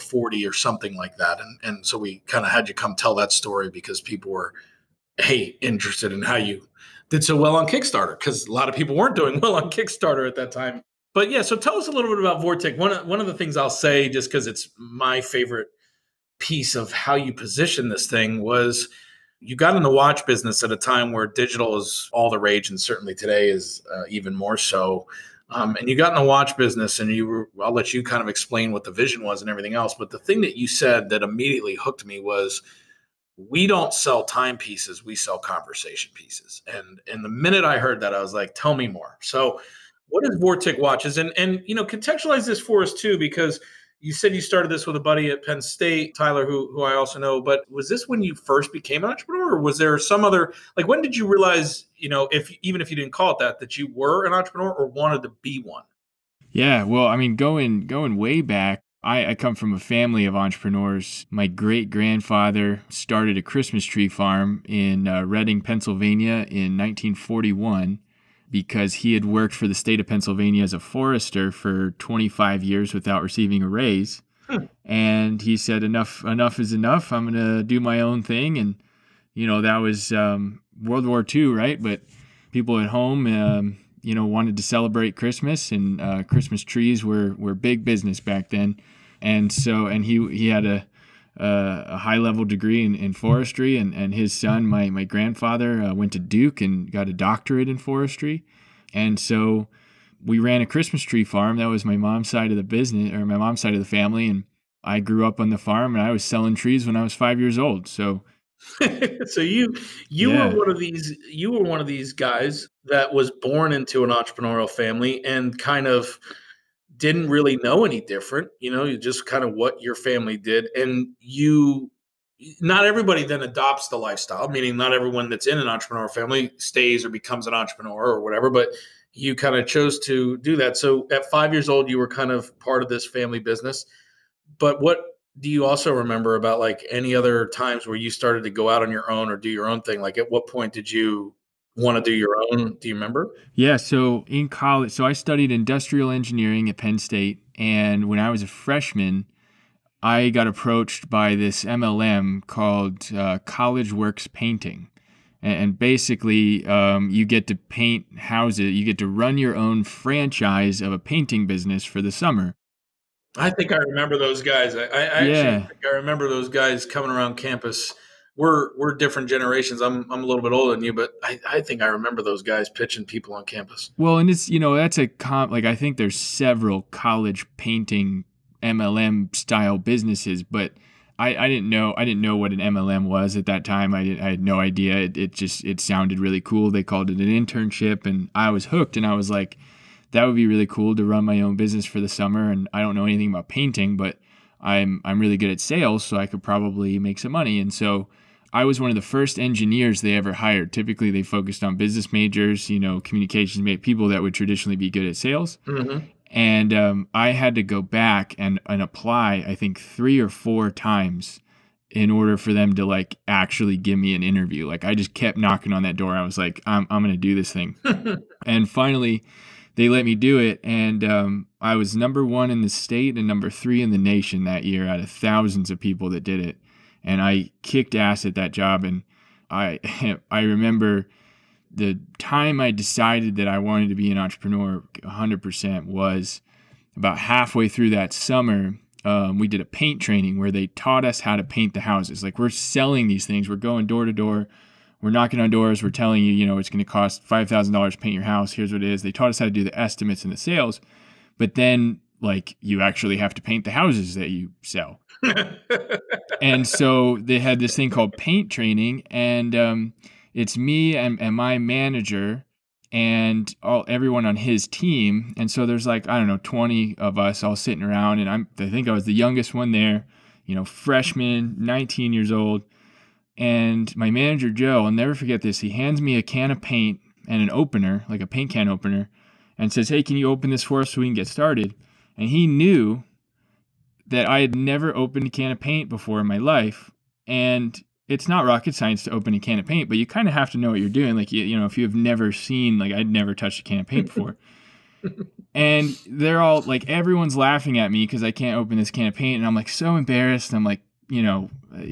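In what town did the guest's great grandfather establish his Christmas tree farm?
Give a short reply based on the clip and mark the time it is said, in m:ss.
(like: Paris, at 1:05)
Reading, Pennsylvania, at 1:05.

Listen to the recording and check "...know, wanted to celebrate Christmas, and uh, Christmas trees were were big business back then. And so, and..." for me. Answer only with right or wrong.
right.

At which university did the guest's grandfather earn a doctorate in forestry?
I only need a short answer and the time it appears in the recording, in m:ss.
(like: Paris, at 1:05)
Duke, at 1:36.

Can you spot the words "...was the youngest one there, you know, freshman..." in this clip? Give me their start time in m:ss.
4:28.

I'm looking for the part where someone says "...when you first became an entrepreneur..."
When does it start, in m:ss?
0:48.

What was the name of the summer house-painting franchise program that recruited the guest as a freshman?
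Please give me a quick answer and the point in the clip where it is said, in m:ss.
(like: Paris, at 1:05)
College Works Painting, at 2:33.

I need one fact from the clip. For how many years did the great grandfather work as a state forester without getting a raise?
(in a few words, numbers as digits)
25.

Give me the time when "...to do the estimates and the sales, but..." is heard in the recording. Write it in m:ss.
4:09.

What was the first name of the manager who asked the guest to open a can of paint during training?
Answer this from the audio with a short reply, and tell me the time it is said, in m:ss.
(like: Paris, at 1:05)
Joe, at 4:34.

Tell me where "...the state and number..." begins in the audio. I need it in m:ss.
3:42.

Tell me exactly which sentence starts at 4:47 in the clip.
And it's not rocket science to open a can of paint, but you kind of have to know what you're doing.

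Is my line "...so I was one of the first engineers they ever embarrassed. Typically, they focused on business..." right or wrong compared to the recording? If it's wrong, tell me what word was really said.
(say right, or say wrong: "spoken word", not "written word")
wrong: "hired", not "embarrassed".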